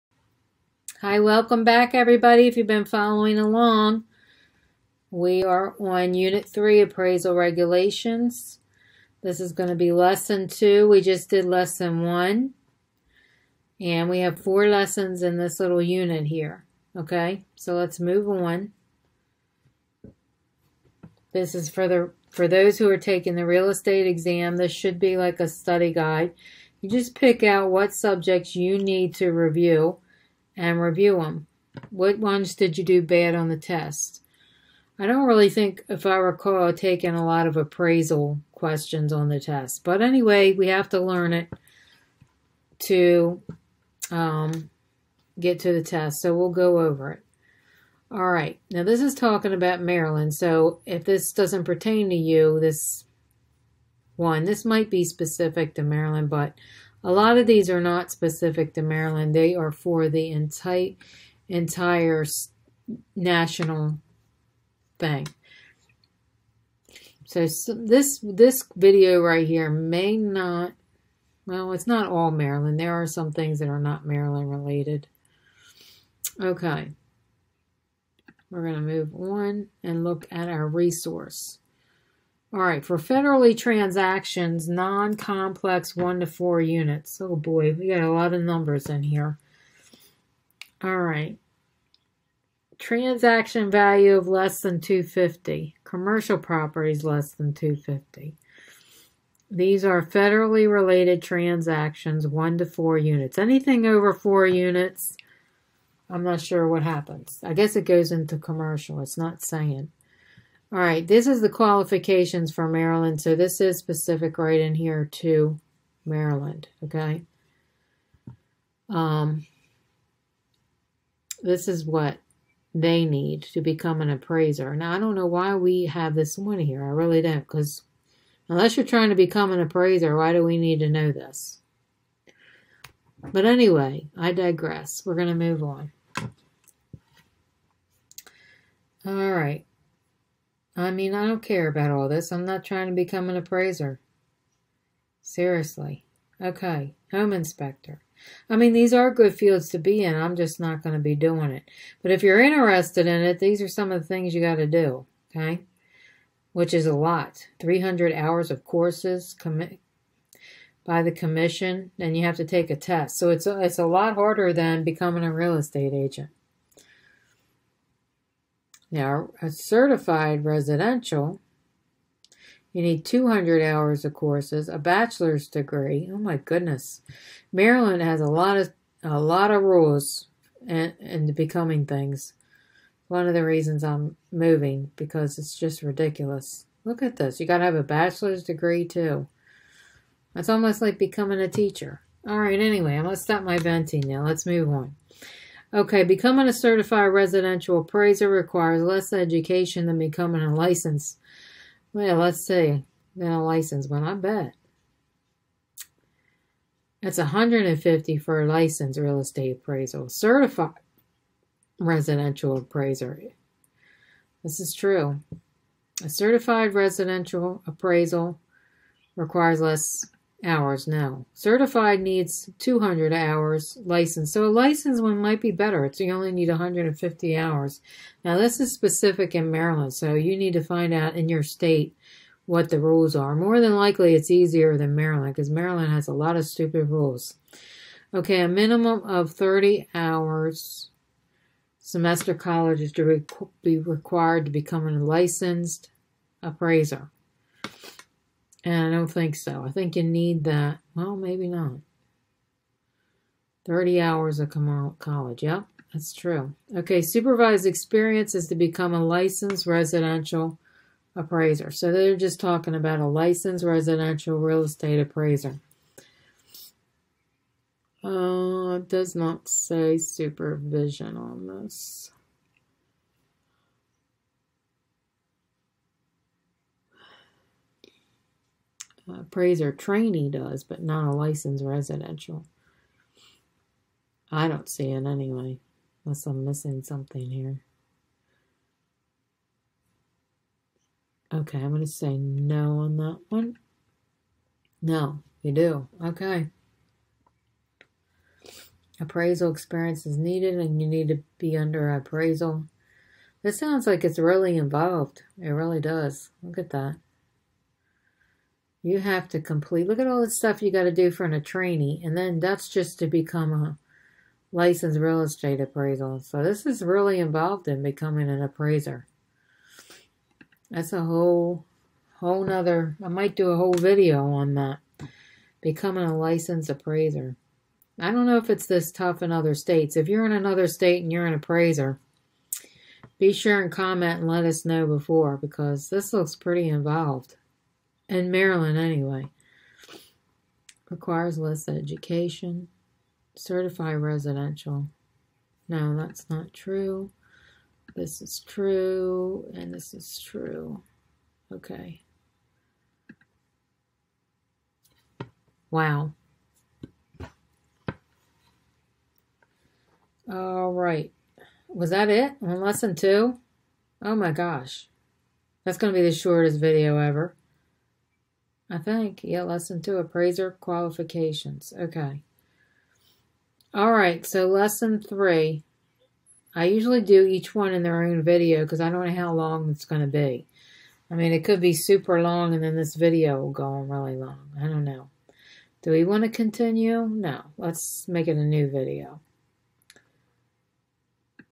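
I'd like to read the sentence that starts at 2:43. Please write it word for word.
So it's a, it's a lot harder than becoming a real estate agent.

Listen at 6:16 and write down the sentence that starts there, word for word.
I usually do each one in their own video because I don't know how long it's going to be.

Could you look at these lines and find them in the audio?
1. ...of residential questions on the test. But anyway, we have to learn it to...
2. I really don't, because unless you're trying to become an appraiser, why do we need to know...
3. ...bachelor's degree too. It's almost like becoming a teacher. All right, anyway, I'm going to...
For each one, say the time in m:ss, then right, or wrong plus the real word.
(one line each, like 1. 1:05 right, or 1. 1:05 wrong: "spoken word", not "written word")
1. 0:37 wrong: "appraisal", not "residential"
2. 2:06 right
3. 3:07 right.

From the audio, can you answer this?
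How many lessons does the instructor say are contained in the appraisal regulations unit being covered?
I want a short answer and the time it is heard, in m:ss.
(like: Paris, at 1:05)
4, at 0:14.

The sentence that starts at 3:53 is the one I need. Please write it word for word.
More than likely it's easier than Maryland because Maryland has a lot of stupid rules.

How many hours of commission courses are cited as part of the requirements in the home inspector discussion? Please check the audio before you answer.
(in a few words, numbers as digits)
300 hours.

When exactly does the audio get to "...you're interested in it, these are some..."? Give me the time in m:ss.
2:32.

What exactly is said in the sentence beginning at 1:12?
There are some things that are not Maryland related.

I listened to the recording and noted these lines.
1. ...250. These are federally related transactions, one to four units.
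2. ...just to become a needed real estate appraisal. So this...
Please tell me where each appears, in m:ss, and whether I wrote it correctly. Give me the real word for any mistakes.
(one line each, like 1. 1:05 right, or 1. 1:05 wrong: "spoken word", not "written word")
1. 1:37 right
2. 5:12 wrong: "licensed", not "needed".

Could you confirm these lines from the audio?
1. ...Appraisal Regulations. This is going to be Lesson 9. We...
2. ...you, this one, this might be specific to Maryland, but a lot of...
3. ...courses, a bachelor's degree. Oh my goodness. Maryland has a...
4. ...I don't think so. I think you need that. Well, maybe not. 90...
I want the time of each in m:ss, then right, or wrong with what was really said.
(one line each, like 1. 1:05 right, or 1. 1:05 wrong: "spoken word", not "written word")
1. 0:06 wrong: "2", not "9"
2. 0:52 right
3. 2:54 right
4. 4:08 wrong: "30", not "90".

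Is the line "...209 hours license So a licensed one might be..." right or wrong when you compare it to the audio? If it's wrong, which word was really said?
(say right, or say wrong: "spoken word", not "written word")
wrong: "200", not "209".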